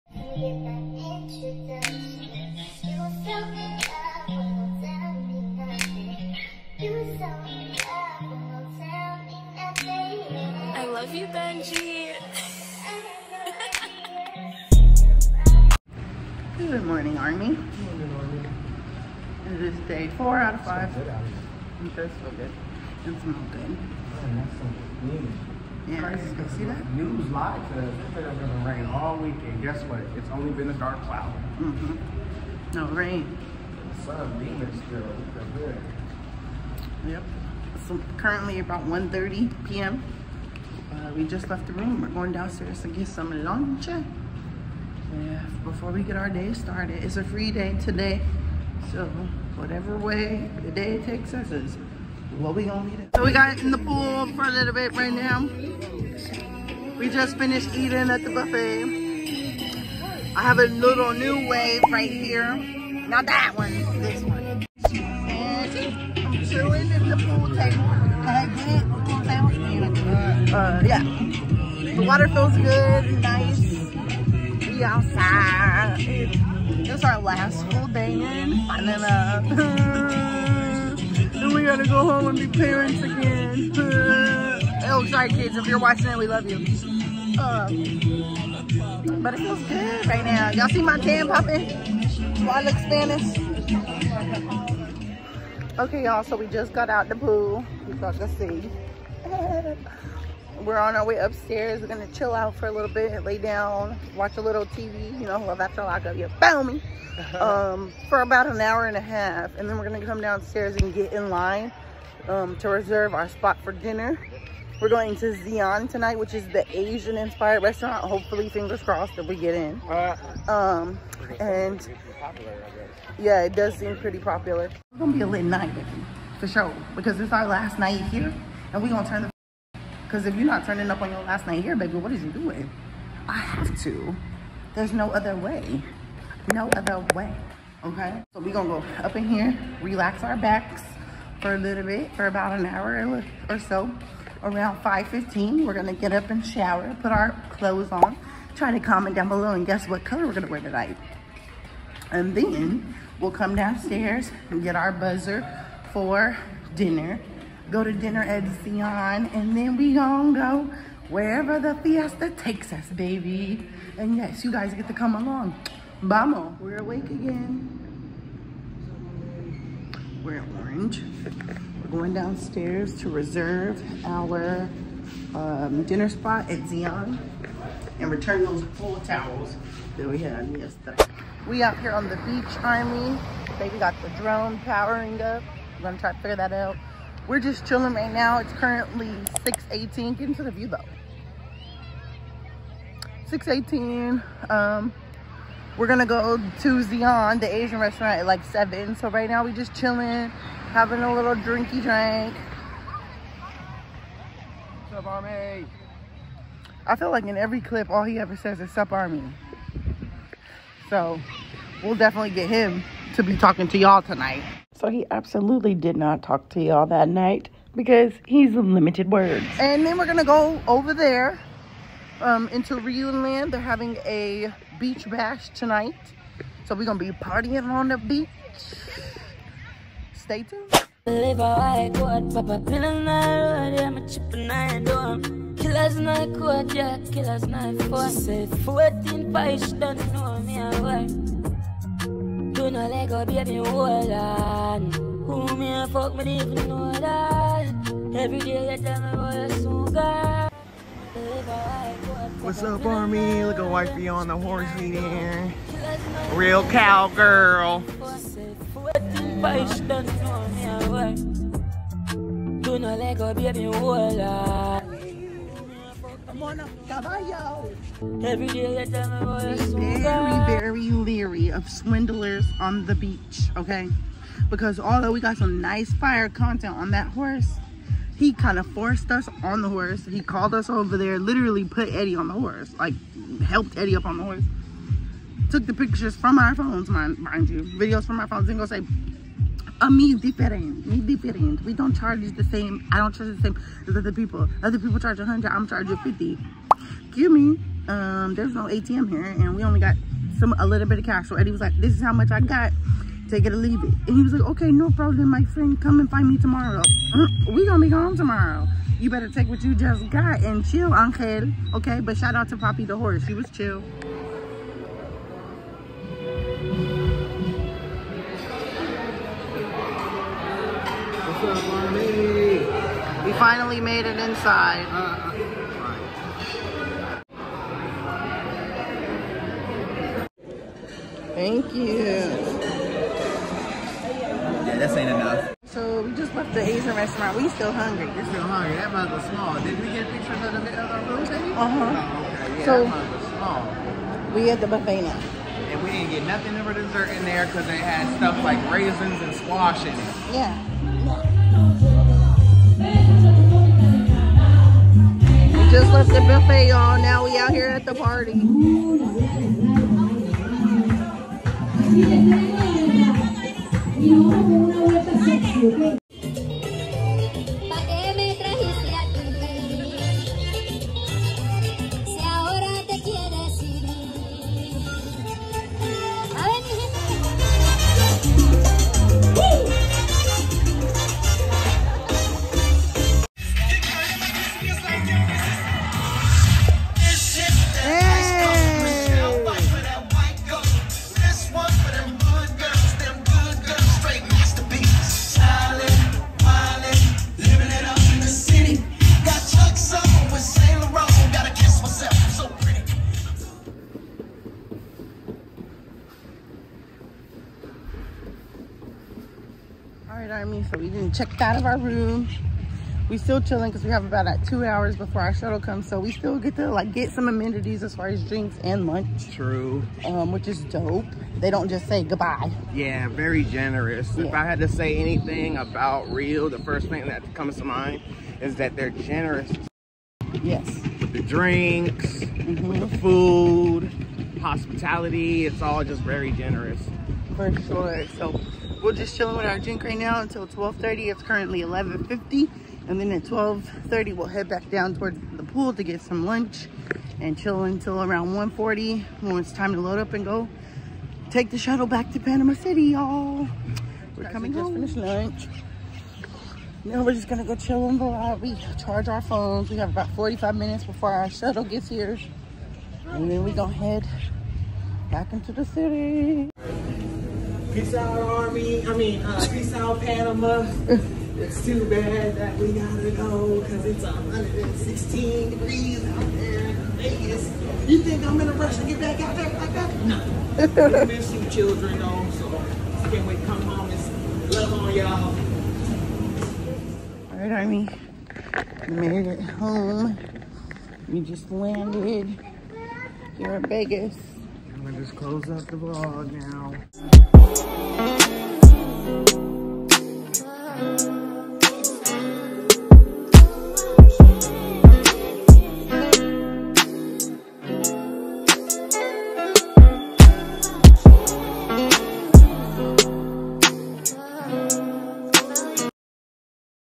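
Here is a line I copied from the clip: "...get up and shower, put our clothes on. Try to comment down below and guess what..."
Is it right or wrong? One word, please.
right.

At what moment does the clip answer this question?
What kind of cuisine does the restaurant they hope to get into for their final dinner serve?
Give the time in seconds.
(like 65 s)
116 s.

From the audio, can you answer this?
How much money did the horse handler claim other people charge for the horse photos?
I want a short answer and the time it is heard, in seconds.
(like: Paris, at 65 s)
100, at 295 s.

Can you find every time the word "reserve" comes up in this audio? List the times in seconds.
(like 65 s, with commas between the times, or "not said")
112 s, 173 s.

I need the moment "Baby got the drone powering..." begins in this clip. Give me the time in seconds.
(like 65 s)
183 s.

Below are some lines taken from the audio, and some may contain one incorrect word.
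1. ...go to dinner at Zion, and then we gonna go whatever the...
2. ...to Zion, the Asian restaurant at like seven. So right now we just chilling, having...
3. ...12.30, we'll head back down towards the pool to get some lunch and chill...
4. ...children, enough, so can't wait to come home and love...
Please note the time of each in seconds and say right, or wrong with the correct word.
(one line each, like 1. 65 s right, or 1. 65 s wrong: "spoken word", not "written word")
1. 157 s wrong: "wherever", not "whatever"
2. 196 s right
3. 443 s right
4. 481 s wrong: "though", not "enough".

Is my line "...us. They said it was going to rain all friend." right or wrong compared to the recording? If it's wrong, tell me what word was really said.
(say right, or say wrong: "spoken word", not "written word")
wrong: "weekend", not "friend".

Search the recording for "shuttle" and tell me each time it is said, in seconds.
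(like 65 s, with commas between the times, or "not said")
415 s, 451 s, 461 s.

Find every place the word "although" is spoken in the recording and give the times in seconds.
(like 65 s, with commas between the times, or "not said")
274 s.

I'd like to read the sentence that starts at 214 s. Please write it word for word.
So he absolutely did not talk to y'all that night because he's limited words.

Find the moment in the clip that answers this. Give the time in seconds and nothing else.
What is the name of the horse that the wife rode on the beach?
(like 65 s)
312 s.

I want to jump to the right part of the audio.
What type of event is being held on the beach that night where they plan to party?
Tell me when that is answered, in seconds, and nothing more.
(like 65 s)
224 s.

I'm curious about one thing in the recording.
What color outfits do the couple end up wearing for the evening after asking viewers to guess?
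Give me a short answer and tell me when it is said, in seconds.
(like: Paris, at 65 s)
Orange, at 170 s.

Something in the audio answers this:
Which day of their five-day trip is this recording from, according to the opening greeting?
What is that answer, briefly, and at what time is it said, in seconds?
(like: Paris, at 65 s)
Day 4, at 19 s.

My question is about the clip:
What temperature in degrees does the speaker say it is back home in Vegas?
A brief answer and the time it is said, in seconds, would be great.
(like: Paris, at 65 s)
116, at 474 s.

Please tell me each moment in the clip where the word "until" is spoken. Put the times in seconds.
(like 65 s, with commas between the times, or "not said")
440 s, 447 s.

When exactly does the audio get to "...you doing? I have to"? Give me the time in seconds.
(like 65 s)
132 s.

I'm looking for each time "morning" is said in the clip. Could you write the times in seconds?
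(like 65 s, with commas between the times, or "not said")
16 s.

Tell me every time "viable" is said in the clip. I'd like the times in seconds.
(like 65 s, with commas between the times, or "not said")
not said.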